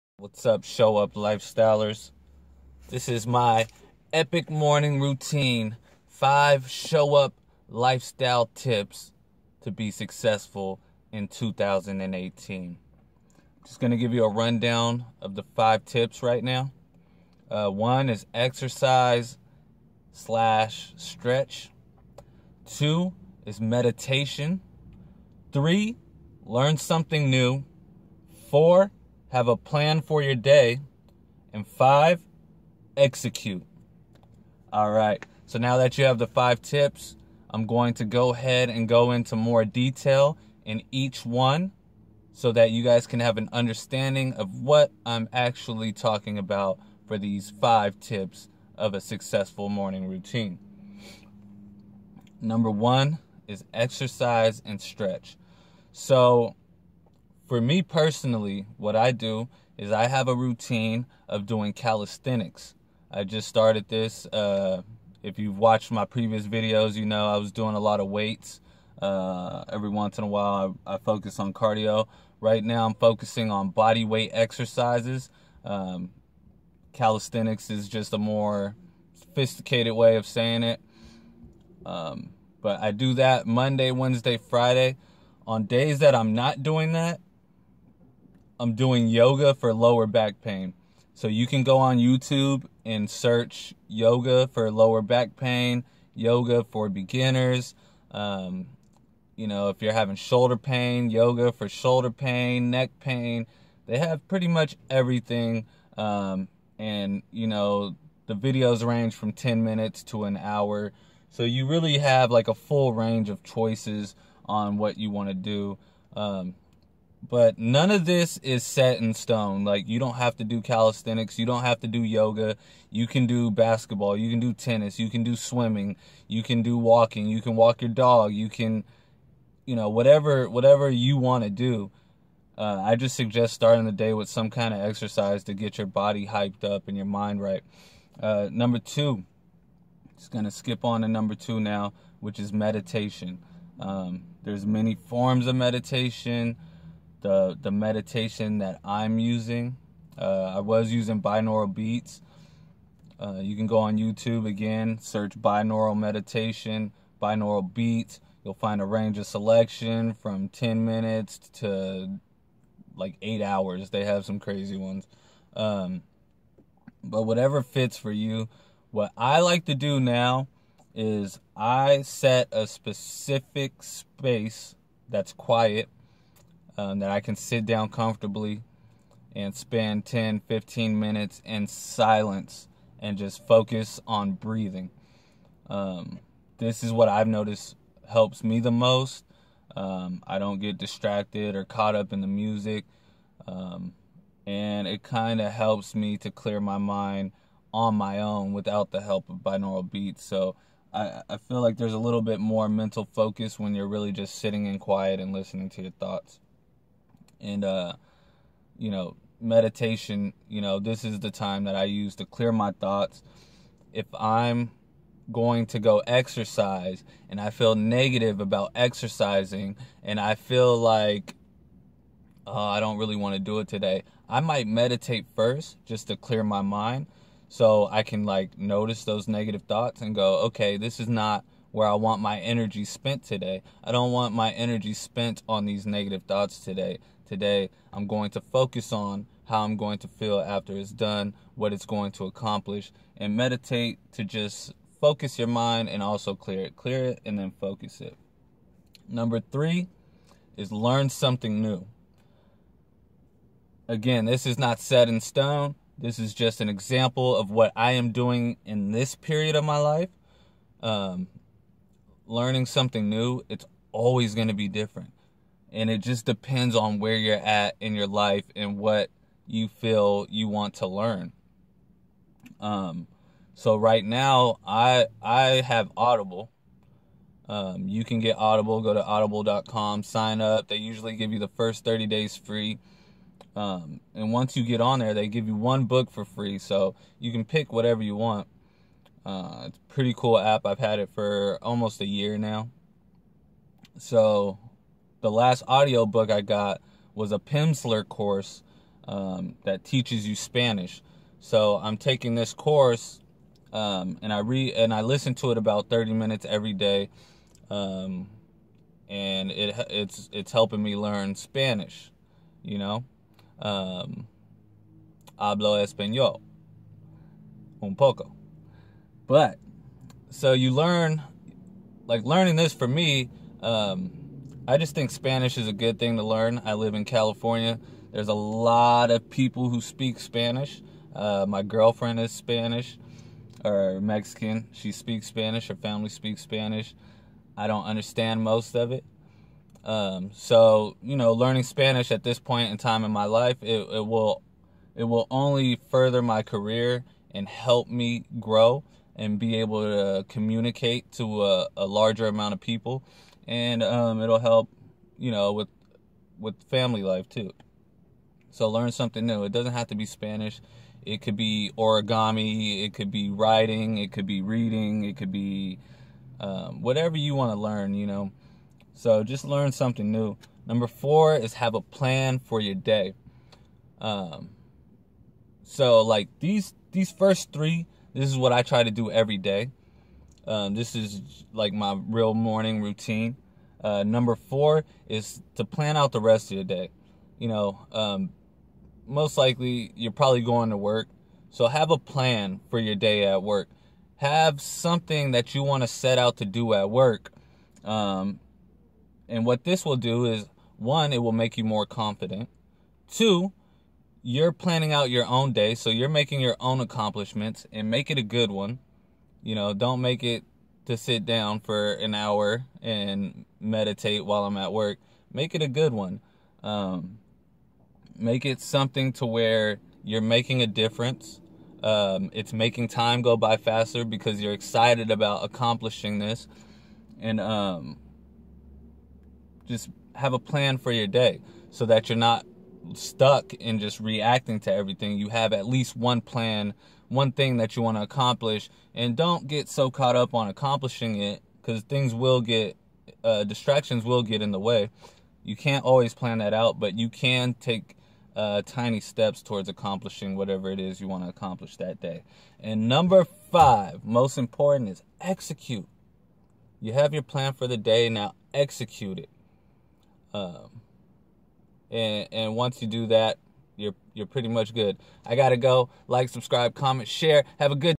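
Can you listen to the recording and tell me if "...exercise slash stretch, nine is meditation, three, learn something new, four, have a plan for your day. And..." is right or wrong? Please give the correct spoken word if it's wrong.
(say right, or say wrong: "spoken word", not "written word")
wrong: "two", not "nine".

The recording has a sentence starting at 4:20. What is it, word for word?
Um, learning something new, it's always going to be different.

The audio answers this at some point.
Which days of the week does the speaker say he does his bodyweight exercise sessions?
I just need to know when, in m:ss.
1:23.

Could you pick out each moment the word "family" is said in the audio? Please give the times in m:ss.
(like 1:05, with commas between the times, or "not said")
5:35, 5:56.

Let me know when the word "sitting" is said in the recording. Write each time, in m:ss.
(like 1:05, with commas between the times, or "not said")
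3:24.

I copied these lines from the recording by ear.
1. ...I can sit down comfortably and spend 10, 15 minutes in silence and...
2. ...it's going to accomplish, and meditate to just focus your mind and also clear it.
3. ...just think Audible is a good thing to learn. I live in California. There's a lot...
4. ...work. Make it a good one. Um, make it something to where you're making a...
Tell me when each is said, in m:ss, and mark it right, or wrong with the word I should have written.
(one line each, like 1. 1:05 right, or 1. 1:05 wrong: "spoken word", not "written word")
1. 2:57 right
2. 4:01 right
3. 5:24 wrong: "Spanish", not "Audible"
4. 6:54 right.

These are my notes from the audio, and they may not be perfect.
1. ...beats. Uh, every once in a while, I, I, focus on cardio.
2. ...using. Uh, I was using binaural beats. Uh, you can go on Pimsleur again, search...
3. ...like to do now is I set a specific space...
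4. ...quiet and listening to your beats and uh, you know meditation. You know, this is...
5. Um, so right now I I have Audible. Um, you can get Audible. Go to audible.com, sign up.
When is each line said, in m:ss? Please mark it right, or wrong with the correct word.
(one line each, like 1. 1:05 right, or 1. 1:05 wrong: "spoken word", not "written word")
1. 1:08 wrong: "weights", not "beats"
2. 2:29 wrong: "YouTube", not "Pimsleur"
3. 2:49 right
4. 3:24 wrong: "thoughts", not "beats"
5. 4:32 right.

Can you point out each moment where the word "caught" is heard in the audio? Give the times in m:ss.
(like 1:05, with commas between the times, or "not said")
3:11, 7:19.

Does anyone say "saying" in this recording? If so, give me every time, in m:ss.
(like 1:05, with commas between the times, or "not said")
1:20.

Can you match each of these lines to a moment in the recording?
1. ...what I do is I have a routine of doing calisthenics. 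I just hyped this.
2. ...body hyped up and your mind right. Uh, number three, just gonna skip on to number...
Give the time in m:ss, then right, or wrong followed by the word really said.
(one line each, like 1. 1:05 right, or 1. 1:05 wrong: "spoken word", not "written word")
1. 0:58 wrong: "started", not "hyped"
2. 2:15 wrong: "two", not "three".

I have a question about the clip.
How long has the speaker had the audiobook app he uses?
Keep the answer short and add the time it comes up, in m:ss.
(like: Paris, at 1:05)
Almost a year, at 4:51.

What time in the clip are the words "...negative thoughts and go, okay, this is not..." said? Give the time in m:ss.
3:49.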